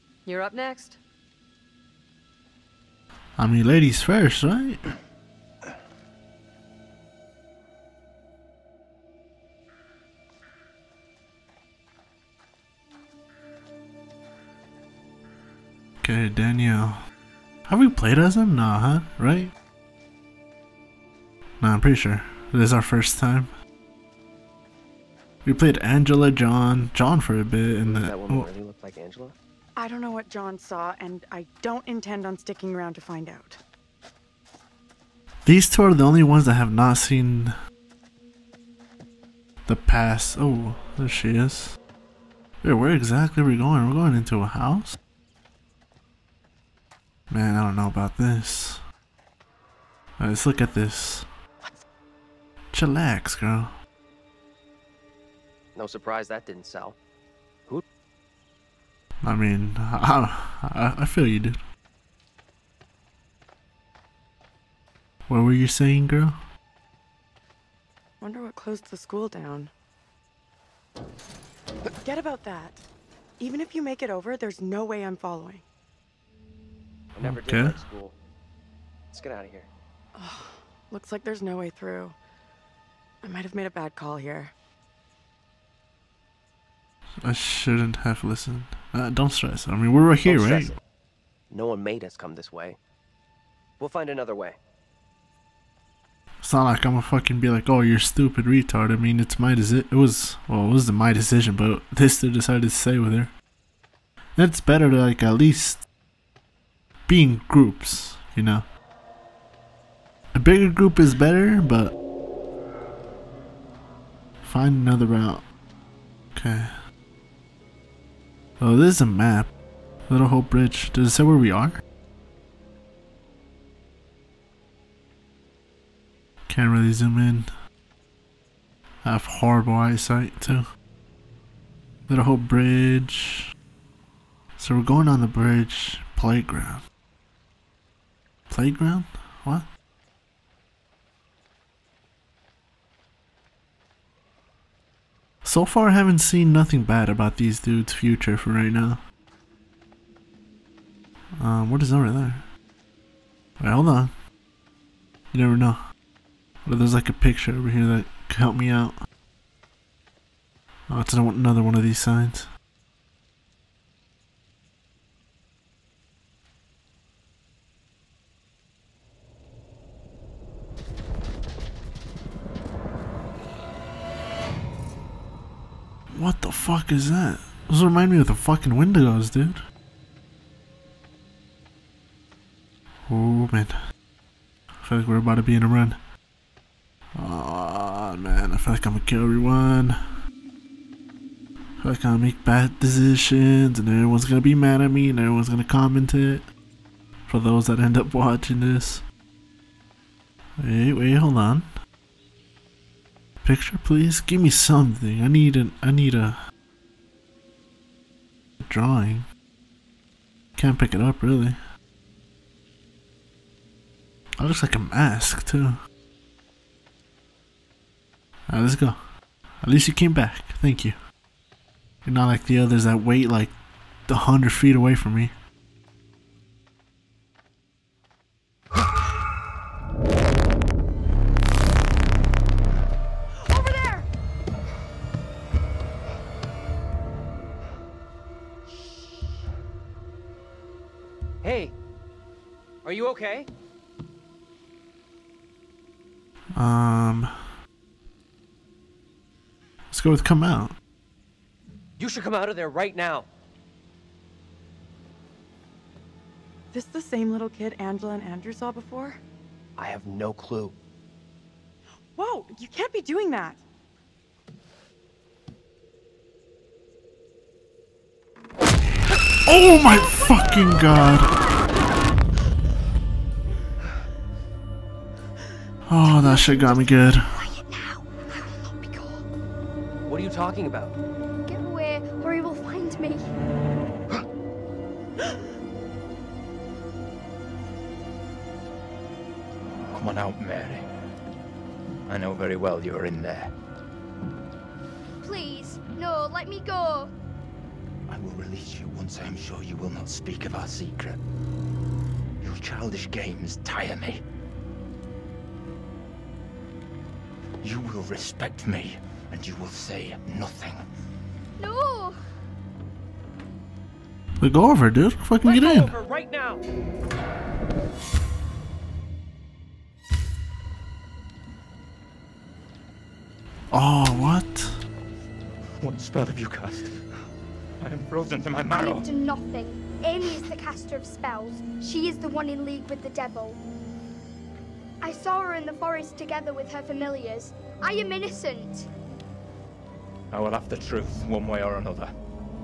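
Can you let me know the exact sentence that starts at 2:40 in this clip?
Oh, it's another one of these signs.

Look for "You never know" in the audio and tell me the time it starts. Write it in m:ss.
2:35.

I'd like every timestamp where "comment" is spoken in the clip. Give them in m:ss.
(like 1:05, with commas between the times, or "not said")
3:15.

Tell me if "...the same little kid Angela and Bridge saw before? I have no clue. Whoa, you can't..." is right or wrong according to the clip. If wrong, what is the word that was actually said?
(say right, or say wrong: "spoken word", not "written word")
wrong: "Andrew", not "Bridge".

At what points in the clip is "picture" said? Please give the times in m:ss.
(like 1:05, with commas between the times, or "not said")
2:37, 3:23.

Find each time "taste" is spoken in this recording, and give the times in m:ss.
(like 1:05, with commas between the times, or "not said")
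not said.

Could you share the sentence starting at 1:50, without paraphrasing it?
A bigger group is better, but find another route.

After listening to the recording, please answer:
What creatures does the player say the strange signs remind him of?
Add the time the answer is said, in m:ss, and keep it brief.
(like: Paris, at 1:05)
Wendigos, at 2:58.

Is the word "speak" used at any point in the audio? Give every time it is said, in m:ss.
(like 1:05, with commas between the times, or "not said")
5:00.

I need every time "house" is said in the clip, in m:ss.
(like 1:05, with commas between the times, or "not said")
0:44.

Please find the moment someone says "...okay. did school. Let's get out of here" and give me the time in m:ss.
1:17.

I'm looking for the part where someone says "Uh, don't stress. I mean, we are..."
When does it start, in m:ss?
1:28.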